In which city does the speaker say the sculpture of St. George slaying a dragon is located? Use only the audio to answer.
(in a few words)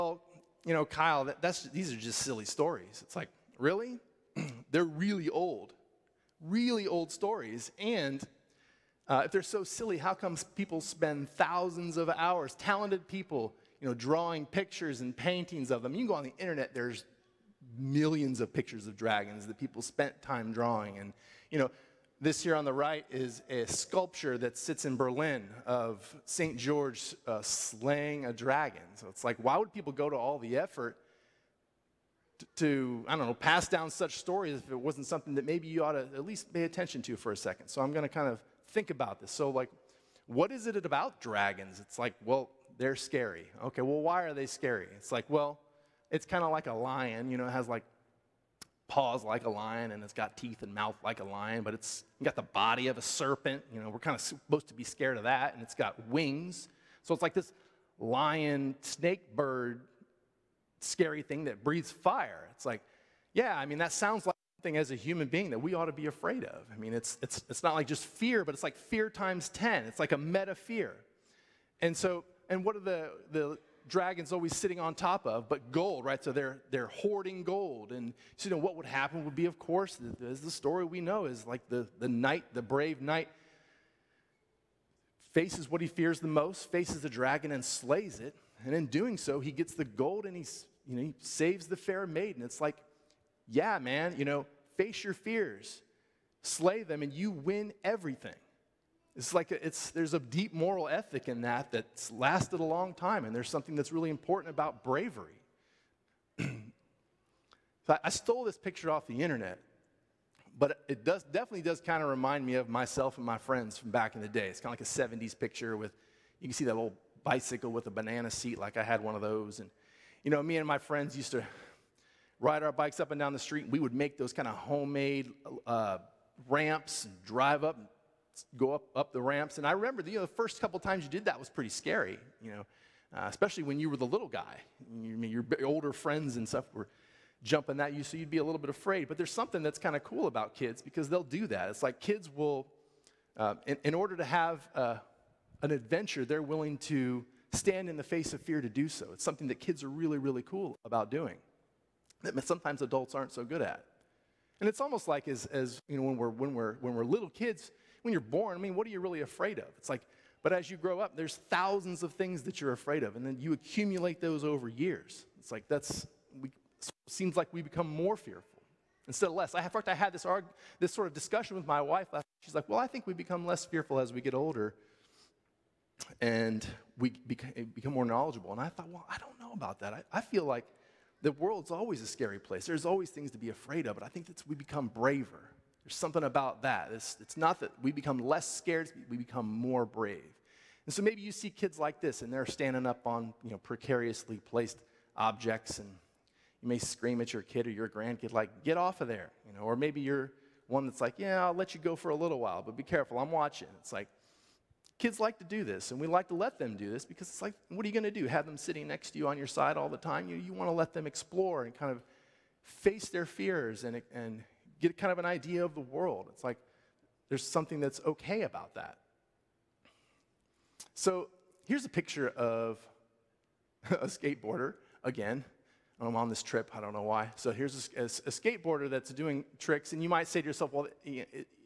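Berlin.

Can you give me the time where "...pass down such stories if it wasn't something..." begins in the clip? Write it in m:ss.
0:33.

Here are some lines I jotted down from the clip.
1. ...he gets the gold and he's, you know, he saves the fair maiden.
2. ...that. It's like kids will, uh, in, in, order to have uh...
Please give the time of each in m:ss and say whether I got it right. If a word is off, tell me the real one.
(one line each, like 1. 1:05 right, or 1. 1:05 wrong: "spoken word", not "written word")
1. 1:29 right
2. 2:21 right.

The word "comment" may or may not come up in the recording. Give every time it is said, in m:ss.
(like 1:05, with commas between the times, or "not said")
not said.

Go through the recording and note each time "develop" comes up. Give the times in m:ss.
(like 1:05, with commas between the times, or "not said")
not said.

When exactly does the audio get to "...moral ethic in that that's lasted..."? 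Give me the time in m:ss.
1:40.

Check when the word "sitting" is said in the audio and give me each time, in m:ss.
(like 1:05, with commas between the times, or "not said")
1:14, 3:28.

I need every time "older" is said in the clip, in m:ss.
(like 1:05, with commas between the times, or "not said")
2:15, 2:54.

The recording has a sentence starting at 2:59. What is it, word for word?
I, I feel like the world's always a scary place.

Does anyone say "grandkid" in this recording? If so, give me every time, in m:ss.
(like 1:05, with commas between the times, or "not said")
3:17.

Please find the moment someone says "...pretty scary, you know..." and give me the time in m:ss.
2:11.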